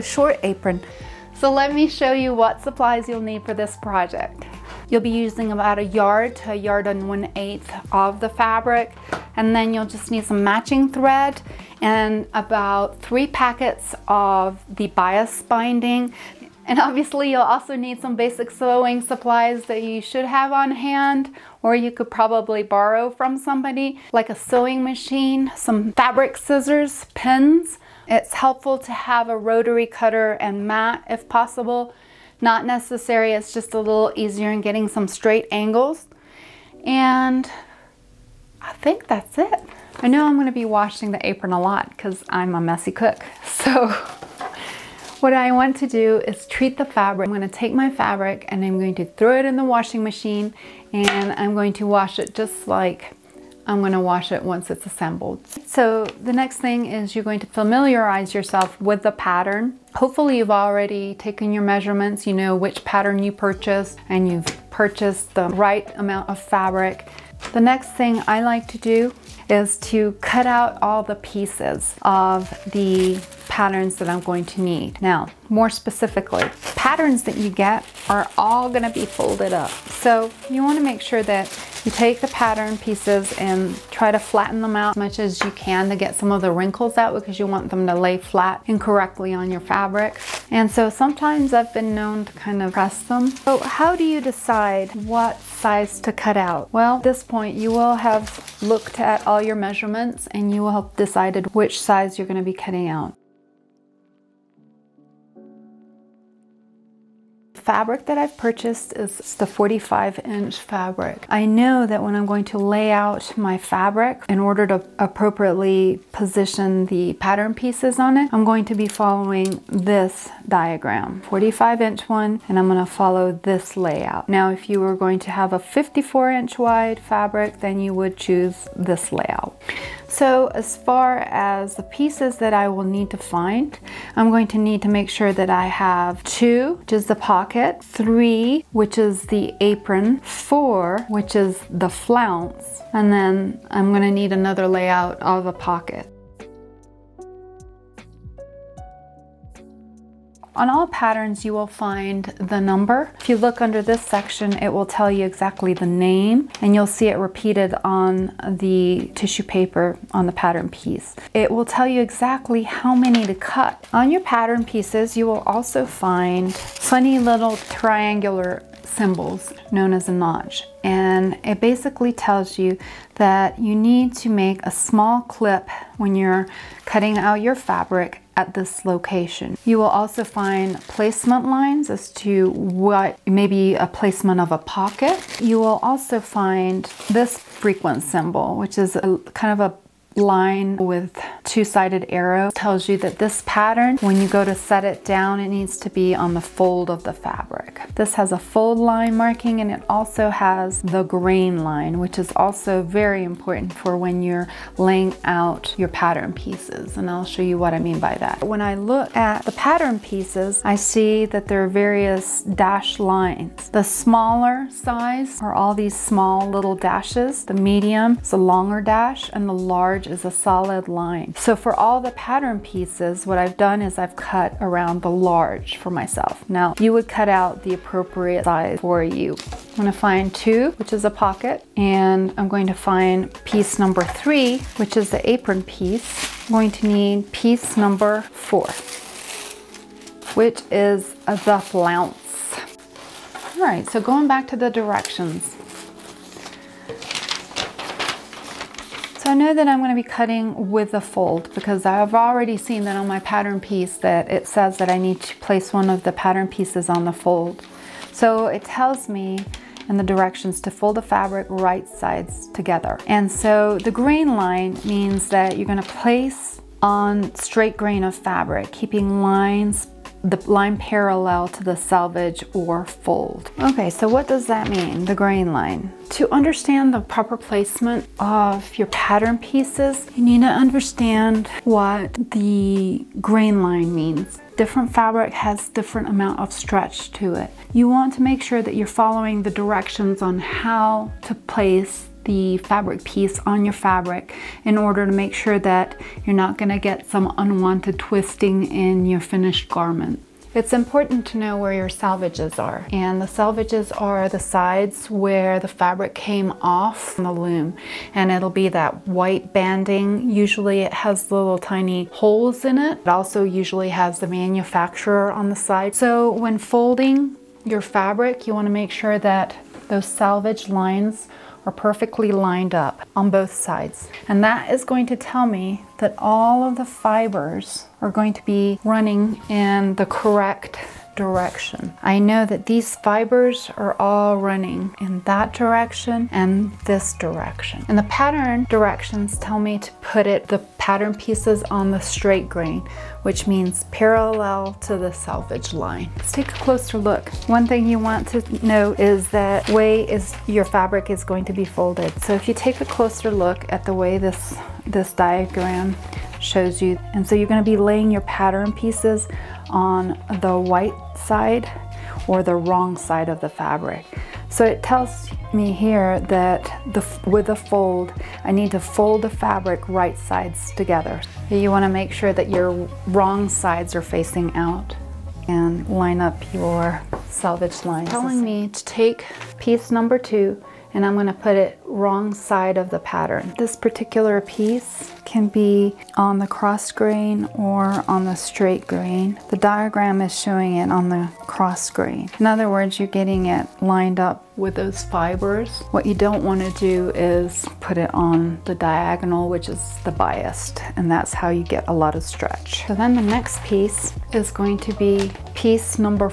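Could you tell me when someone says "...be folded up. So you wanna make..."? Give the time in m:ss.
1:18.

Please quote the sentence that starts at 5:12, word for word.
It also usually has the manufacturer on the side.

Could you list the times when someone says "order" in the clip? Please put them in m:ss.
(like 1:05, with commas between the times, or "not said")
1:54, 4:54.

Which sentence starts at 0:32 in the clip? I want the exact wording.
Not necessary, it's just a little easier in getting some straight angles.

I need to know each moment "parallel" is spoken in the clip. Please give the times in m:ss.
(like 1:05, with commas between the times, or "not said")
4:30, 5:43.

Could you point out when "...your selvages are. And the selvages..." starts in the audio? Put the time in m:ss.
5:01.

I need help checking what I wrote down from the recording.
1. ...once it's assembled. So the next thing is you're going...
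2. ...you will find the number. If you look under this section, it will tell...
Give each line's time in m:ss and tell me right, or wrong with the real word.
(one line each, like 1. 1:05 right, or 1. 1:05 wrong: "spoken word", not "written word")
1. 0:54 right
2. 2:31 right.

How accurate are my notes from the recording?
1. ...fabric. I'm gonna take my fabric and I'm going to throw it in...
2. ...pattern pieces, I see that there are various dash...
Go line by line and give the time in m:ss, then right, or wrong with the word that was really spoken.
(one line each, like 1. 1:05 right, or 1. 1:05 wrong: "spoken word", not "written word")
1. 0:46 right
2. 3:29 right.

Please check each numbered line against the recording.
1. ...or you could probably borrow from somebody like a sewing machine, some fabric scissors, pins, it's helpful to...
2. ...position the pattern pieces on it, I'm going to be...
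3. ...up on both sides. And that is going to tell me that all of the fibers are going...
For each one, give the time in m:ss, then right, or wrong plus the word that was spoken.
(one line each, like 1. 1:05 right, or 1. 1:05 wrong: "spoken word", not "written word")
1. 0:21 right
2. 1:56 right
3. 5:22 right.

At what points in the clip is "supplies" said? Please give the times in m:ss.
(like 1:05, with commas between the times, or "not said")
0:02, 0:19.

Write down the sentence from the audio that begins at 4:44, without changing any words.
Different fabric has different amount of stretch to it.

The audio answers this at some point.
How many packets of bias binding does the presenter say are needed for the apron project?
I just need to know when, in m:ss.
0:13.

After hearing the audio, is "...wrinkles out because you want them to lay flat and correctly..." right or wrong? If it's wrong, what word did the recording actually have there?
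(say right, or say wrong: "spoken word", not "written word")
right.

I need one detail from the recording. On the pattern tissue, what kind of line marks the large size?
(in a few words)
solid line.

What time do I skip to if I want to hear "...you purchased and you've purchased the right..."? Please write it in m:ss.
1:03.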